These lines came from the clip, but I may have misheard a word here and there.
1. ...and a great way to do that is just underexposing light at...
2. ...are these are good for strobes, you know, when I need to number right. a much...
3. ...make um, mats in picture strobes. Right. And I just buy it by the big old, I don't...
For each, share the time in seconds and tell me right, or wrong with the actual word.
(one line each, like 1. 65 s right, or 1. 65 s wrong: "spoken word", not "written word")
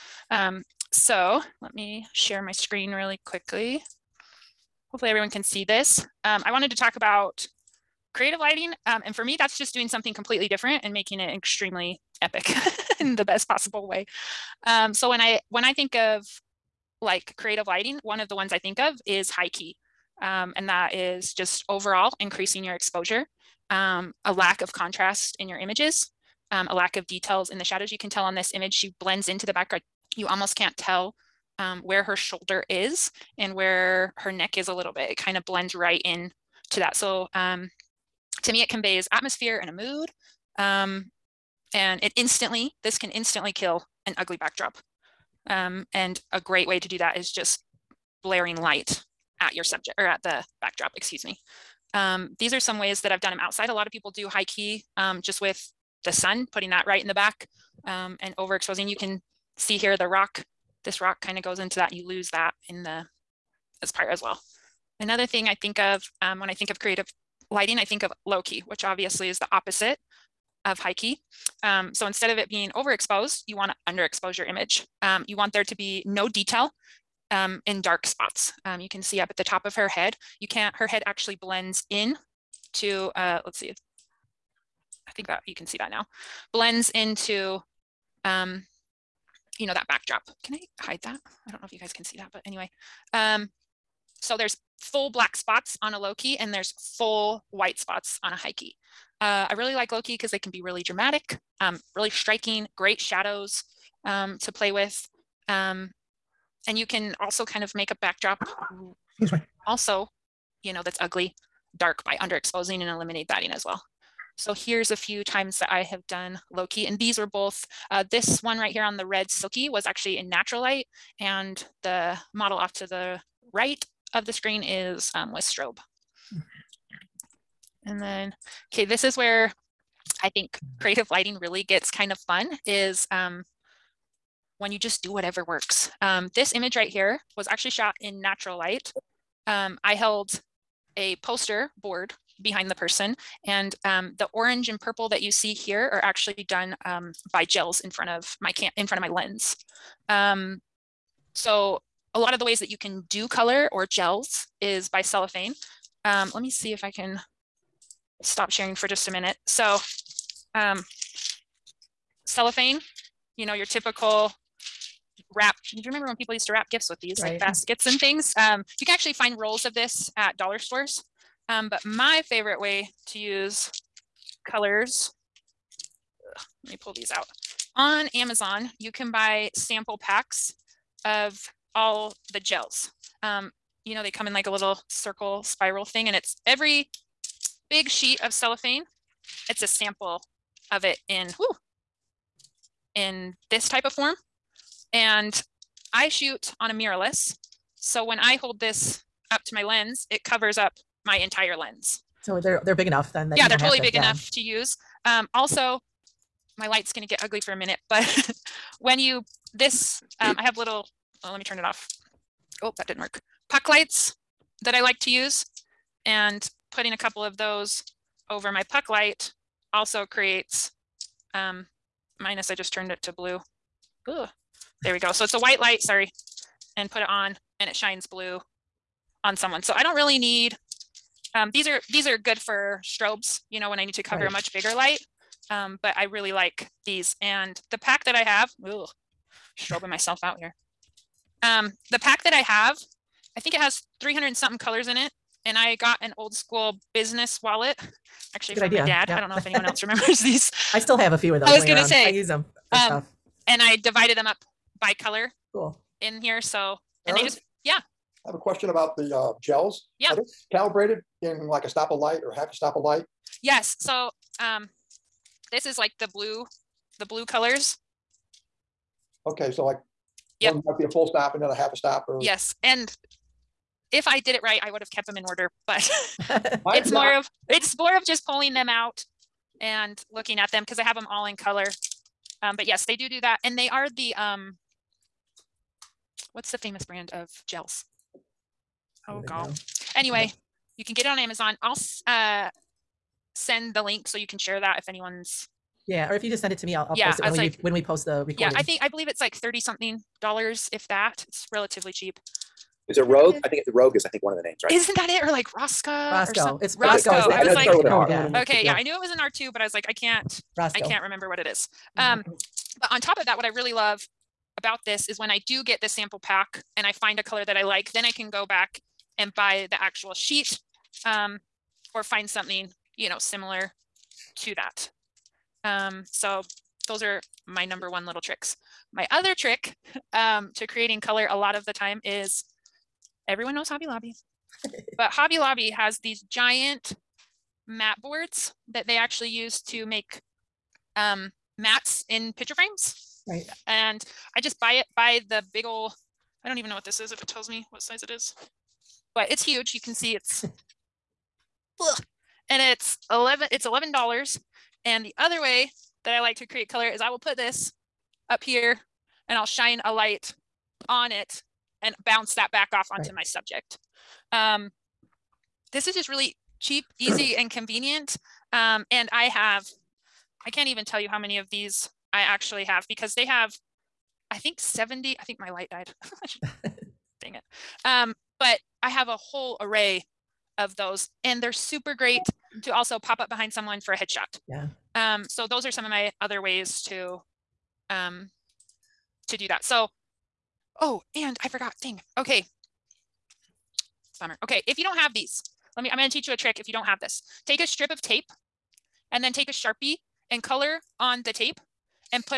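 1. 45 s wrong: "blaring", not "underexposing"
2. 231 s wrong: "cover", not "number"
3. 339 s wrong: "frames", not "strobes".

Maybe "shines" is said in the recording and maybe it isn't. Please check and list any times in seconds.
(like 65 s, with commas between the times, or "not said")
227 s, 359 s.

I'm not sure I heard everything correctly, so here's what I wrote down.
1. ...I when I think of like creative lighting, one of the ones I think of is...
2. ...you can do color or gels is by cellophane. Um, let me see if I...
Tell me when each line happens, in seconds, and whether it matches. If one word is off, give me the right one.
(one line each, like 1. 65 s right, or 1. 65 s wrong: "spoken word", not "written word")
1. 15 s right
2. 152 s right.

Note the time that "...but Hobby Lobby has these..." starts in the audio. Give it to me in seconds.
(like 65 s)
334 s.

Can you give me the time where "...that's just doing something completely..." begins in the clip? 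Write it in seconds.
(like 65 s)
9 s.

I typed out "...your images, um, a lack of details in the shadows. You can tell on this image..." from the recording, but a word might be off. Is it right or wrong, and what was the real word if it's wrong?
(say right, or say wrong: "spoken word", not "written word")
right.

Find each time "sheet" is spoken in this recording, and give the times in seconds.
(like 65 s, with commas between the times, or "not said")
187 s, 320 s.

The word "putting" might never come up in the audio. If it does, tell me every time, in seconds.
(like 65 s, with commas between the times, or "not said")
56 s, 216 s.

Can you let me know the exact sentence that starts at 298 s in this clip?
Yeah, I think I believe it's like thirty something dollars, if that.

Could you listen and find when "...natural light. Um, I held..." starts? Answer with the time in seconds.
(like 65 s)
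138 s.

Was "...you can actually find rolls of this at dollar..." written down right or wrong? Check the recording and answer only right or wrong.
right.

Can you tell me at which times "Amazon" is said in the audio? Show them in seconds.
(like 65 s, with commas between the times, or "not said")
178 s, 291 s.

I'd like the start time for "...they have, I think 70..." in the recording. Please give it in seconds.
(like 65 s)
373 s.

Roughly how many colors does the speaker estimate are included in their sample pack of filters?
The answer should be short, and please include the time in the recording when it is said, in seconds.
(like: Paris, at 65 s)
300 and something, at 243 s.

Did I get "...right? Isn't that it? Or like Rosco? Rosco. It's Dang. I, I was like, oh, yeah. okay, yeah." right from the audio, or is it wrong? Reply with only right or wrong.
wrong.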